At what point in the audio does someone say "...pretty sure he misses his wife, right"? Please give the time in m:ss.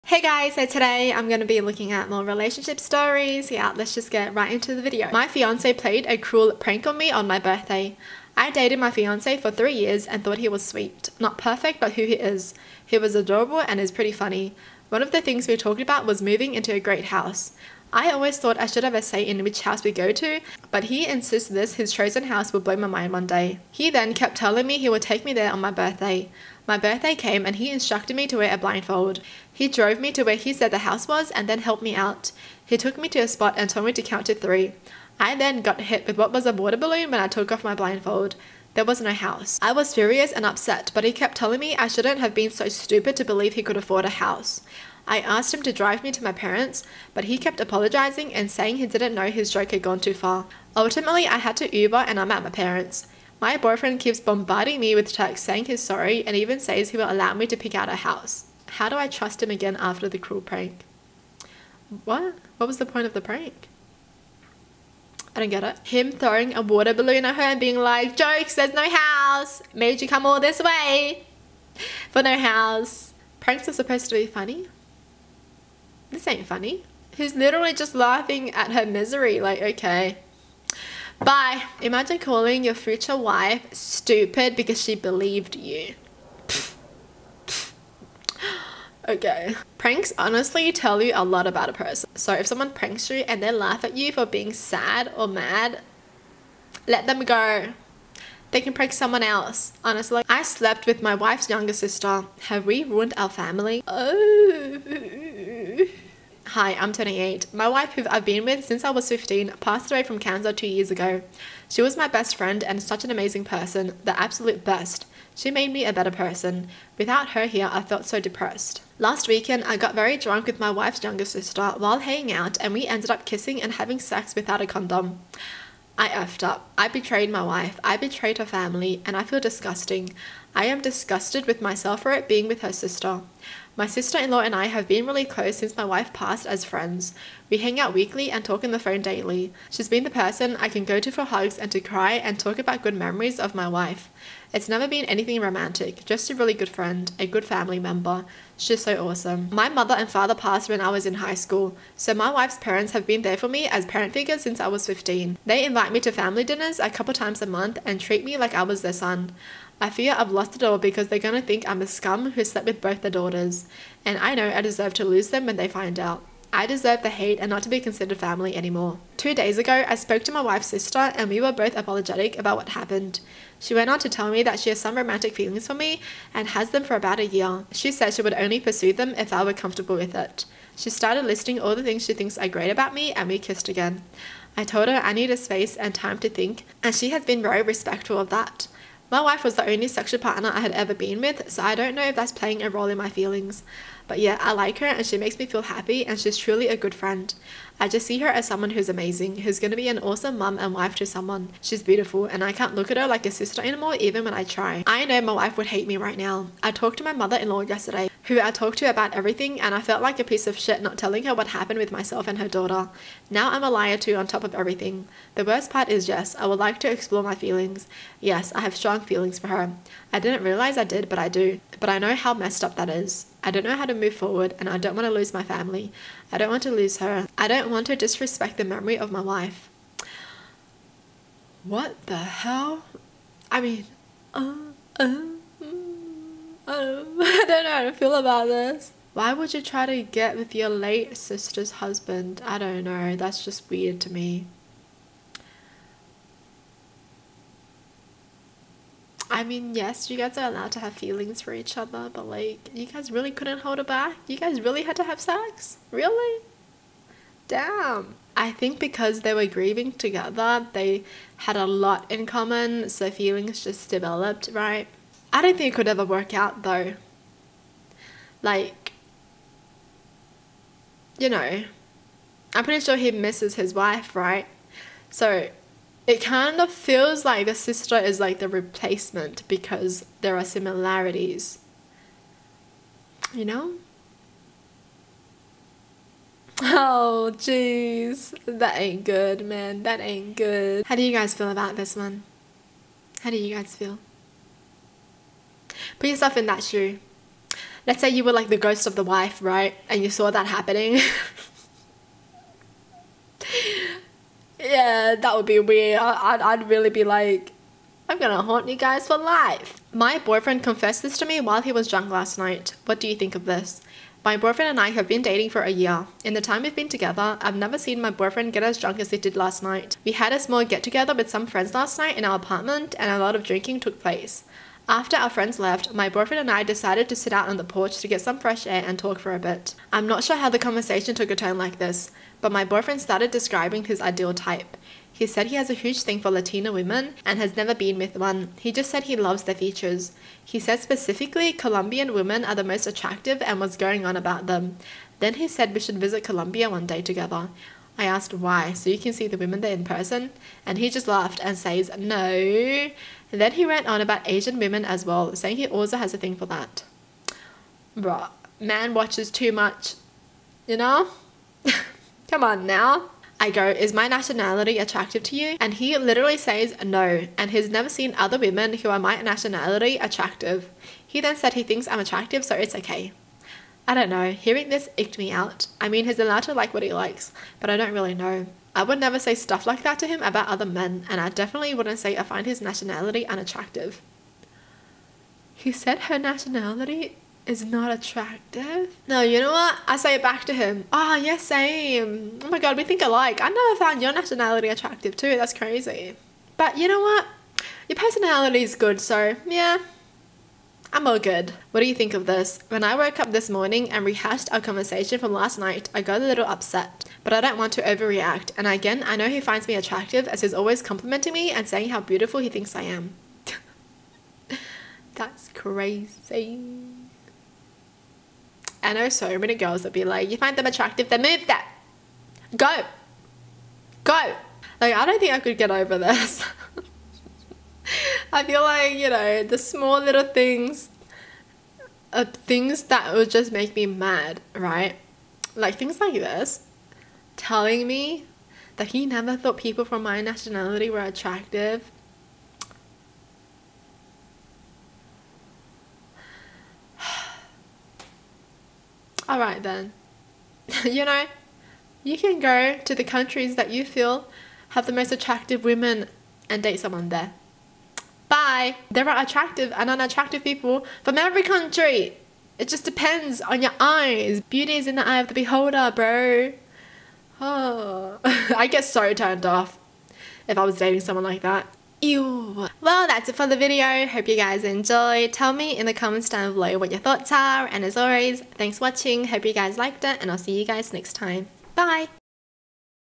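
4:32.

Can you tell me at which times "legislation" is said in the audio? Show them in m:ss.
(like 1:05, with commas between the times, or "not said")
not said.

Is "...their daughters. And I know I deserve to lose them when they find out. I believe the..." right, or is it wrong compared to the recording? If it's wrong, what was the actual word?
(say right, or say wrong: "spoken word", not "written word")
wrong: "deserve", not "believe".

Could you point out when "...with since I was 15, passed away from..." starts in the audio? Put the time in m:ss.
1:48.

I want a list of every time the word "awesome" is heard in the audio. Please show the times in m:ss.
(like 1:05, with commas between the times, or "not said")
2:29, 3:19.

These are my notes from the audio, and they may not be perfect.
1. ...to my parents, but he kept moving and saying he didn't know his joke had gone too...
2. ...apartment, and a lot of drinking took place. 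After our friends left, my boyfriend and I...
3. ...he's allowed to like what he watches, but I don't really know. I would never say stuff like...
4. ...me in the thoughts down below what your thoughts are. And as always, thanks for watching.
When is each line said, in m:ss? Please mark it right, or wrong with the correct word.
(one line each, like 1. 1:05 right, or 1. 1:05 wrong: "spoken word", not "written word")
1. 0:46 wrong: "apologizing", not "moving"
2. 5:22 right
3. 6:16 wrong: "likes", not "watches"
4. 7:55 wrong: "comments", not "thoughts".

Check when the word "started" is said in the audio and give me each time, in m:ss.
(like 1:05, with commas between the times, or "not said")
3:00, 5:32.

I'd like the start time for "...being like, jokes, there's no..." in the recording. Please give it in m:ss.
1:07.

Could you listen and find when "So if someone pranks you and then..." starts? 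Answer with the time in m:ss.
1:32.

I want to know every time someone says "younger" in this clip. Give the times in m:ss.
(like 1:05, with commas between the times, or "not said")
1:41, 2:01.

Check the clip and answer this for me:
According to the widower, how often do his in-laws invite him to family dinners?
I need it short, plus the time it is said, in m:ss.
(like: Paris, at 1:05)
A couple times a month, at 2:36.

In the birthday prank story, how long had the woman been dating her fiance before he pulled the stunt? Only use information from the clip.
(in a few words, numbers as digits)
3 years.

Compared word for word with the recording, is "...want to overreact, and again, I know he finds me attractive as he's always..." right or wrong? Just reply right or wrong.
right.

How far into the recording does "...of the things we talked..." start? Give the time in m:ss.
0:15.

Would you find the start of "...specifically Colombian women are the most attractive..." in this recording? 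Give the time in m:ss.
5:40.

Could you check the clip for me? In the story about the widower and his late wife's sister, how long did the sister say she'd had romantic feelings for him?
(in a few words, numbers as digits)
About a year.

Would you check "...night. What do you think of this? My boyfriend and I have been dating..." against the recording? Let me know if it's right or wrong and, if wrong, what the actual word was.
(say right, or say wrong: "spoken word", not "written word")
right.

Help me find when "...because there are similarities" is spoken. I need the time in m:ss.
4:39.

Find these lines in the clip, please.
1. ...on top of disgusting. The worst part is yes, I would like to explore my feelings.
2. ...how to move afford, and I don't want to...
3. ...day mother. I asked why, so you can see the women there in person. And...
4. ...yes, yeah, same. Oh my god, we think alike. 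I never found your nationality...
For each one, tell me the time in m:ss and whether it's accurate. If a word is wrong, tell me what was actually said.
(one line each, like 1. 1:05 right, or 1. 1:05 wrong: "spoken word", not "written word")
1. 3:34 wrong: "everything", not "disgusting"
2. 3:43 wrong: "forward", not "afford"
3. 5:46 wrong: "together", not "mother"
4. 6:31 right.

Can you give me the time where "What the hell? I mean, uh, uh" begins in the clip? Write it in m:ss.
3:51.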